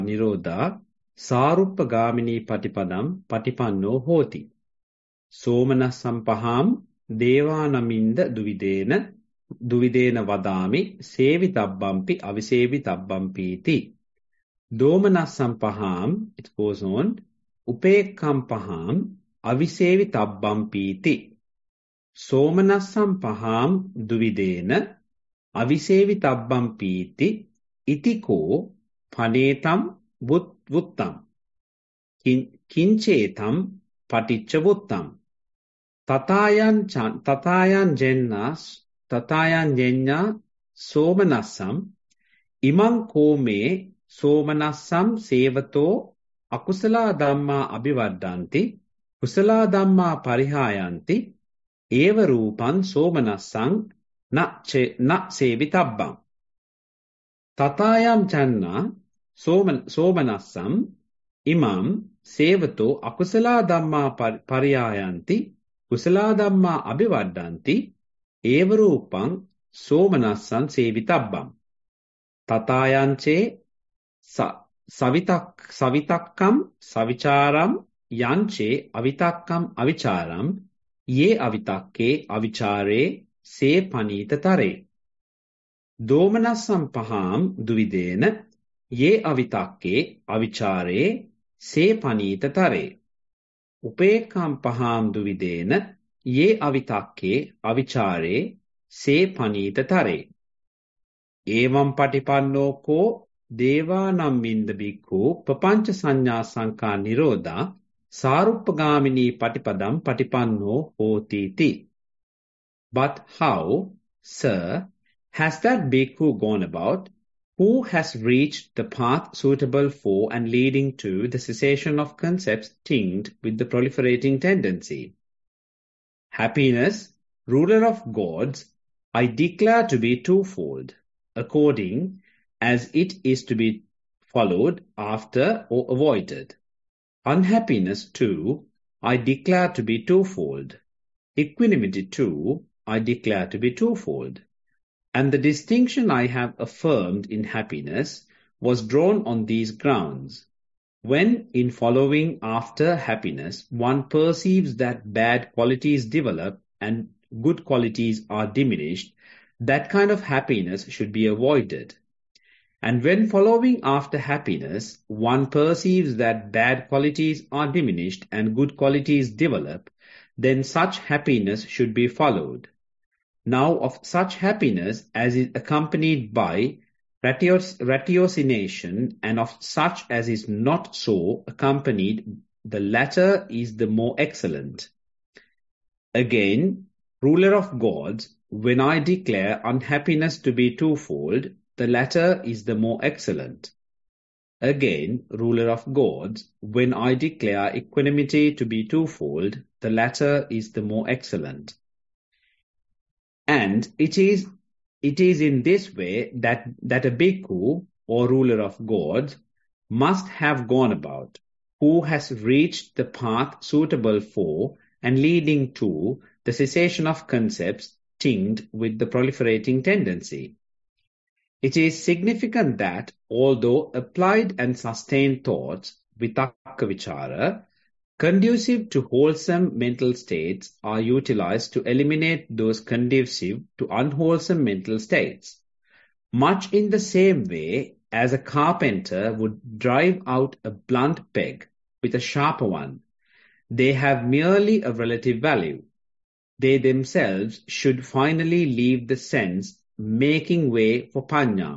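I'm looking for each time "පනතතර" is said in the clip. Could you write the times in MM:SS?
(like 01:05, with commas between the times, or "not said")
01:23, 01:32, 01:39.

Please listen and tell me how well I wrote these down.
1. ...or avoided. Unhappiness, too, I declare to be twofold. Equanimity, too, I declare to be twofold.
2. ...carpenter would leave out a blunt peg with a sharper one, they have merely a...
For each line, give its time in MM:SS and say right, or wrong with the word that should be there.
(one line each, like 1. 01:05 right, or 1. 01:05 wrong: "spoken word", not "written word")
1. 02:15 right
2. 03:58 wrong: "drive", not "leave".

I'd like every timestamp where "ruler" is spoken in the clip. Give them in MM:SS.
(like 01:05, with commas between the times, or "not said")
02:07, 03:07, 03:15, 03:28.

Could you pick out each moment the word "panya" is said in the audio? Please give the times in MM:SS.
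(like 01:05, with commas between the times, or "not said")
04:11.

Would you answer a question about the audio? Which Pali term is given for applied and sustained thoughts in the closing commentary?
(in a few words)
vitakkavichara.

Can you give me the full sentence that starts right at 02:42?
And when following after happiness, one perceives that bad qualities are diminished and good qualities develop, then such happiness should be followed.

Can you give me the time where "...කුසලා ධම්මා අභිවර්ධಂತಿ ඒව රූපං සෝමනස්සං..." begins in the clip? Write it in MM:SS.
01:05.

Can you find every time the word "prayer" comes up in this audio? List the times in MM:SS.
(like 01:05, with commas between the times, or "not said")
not said.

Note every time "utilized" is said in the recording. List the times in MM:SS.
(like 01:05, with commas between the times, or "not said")
03:50.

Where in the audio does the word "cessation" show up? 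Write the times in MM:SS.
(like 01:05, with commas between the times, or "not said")
02:01, 03:36.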